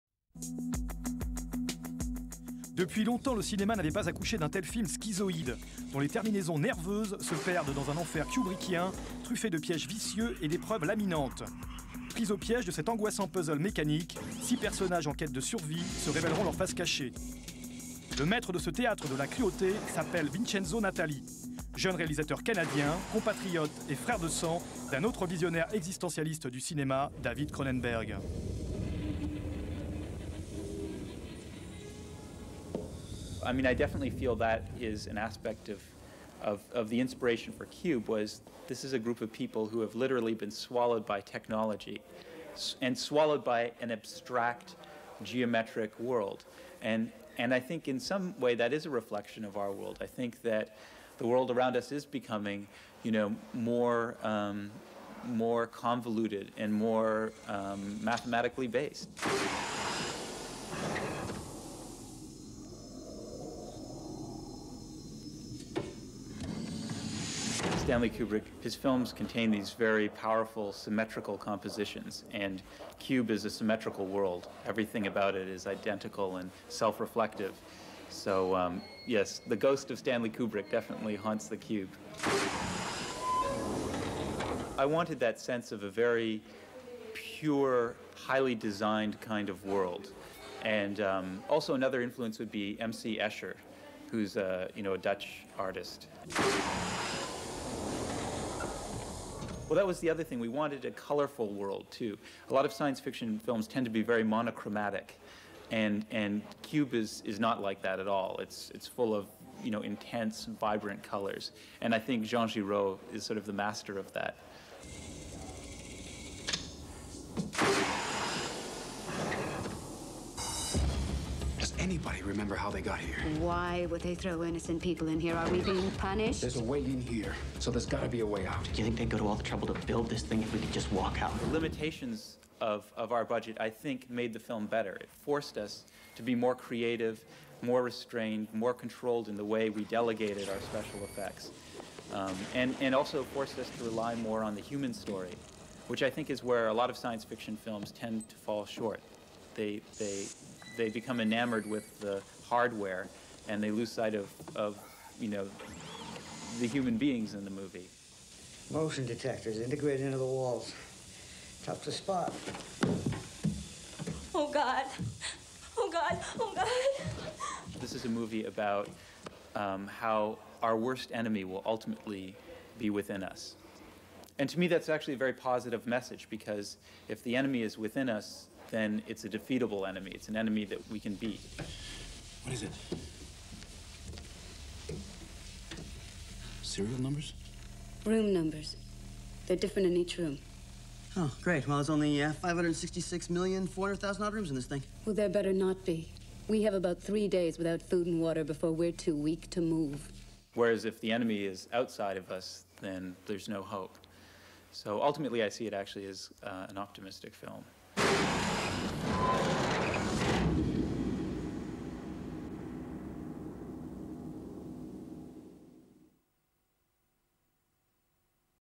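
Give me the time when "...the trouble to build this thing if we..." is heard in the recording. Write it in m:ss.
2:09.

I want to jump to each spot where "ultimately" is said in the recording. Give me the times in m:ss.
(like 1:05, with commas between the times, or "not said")
2:51, 3:25.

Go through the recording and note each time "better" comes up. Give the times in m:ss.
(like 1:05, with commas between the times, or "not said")
2:14, 3:15.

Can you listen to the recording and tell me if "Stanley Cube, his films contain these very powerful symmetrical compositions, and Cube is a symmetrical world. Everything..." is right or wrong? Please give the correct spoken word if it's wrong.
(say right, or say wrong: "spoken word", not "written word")
wrong: "Kubrick", not "Cube".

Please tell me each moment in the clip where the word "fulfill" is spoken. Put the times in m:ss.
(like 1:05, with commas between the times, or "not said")
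not said.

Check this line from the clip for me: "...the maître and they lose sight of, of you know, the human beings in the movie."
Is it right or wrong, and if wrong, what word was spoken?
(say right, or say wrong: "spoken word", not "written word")
wrong: "hardware", not "maître".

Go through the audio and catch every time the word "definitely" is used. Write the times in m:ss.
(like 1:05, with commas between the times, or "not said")
0:33, 1:20.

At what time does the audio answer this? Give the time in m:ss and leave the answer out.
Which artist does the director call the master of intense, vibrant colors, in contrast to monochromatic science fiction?
1:52.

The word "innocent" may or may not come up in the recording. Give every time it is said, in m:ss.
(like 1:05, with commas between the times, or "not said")
2:04.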